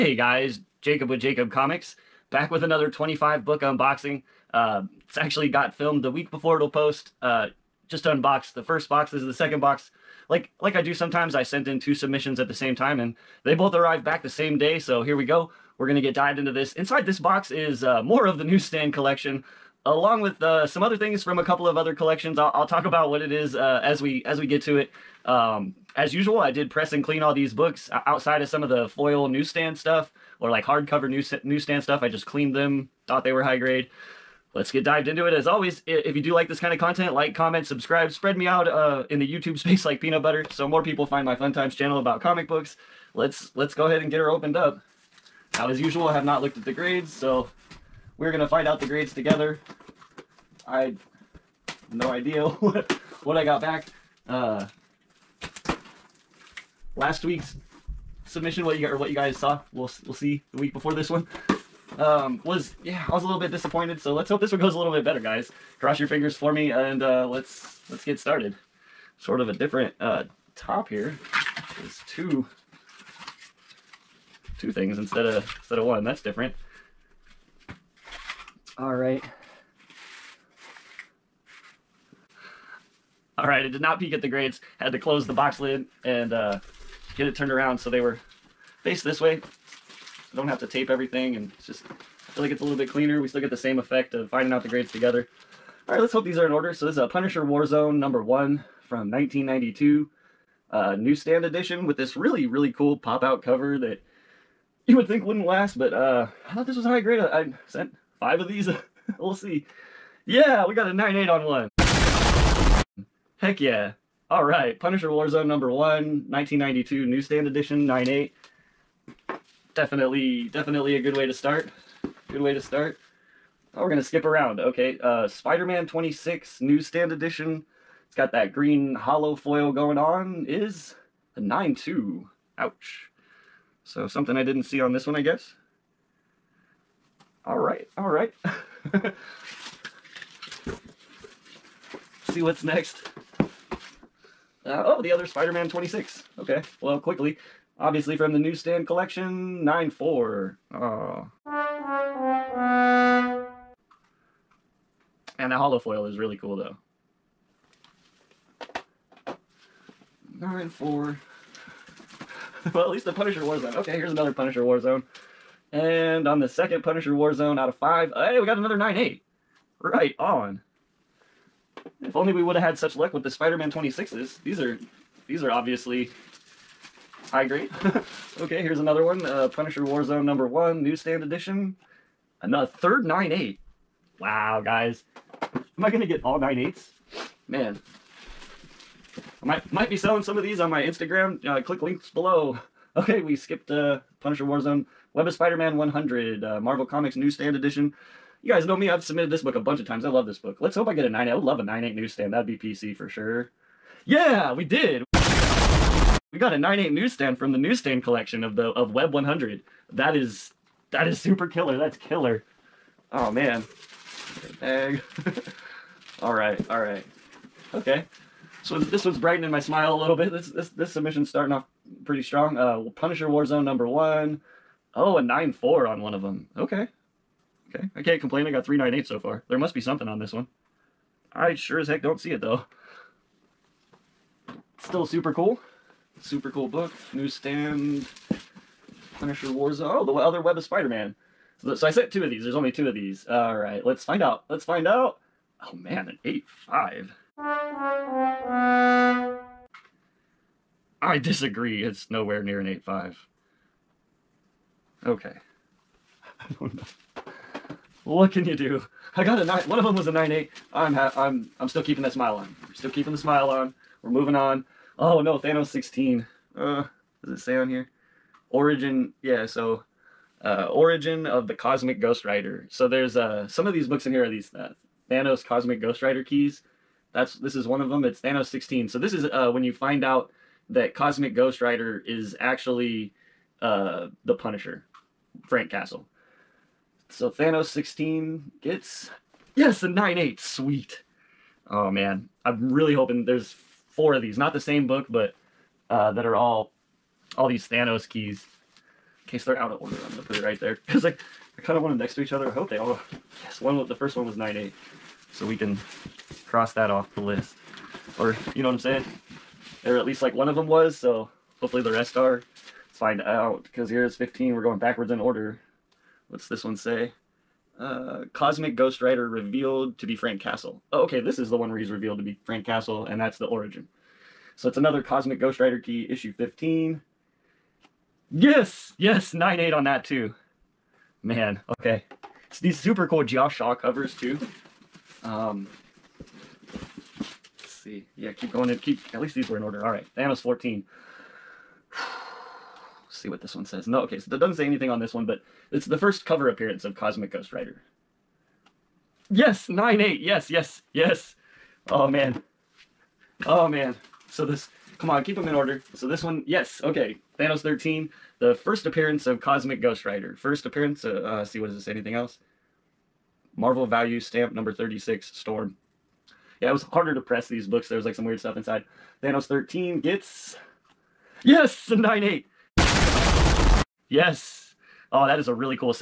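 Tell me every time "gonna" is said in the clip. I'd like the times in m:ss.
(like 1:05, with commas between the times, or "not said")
0:15, 2:03, 5:00.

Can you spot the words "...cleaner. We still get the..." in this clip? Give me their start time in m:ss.
1:32.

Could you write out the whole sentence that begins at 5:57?
Thanos 13, the first appearance of Cosmic Ghost Rider.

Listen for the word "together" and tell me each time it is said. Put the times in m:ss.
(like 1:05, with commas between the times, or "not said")
0:49, 1:34.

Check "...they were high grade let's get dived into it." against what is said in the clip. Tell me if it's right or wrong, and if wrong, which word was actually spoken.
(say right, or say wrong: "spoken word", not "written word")
right.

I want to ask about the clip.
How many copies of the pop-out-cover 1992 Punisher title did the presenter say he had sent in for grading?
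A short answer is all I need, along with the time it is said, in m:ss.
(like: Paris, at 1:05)
5, at 1:47.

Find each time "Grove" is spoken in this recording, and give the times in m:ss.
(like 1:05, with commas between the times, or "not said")
not said.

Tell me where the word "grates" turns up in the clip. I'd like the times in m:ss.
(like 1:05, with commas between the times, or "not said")
1:24.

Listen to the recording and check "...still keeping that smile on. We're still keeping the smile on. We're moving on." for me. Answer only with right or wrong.
right.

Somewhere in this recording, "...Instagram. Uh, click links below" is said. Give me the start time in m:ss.
3:10.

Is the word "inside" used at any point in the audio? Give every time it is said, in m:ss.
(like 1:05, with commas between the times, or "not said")
0:16, 6:08.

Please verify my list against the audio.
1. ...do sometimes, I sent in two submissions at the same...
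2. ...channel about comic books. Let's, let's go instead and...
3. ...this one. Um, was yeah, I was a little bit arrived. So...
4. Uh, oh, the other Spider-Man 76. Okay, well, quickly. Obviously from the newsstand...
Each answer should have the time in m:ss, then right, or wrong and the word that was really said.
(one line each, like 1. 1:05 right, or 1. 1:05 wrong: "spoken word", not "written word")
1. 0:10 right
2. 0:41 wrong: "ahead", not "instead"
3. 1:00 wrong: "disappointed", not "arrived"
4. 2:23 wrong: "26", not "76".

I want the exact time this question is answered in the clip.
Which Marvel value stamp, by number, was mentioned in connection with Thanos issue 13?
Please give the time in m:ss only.
6:03.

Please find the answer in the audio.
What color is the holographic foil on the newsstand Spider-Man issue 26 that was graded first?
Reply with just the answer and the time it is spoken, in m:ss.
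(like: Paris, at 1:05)
Green, at 2:08.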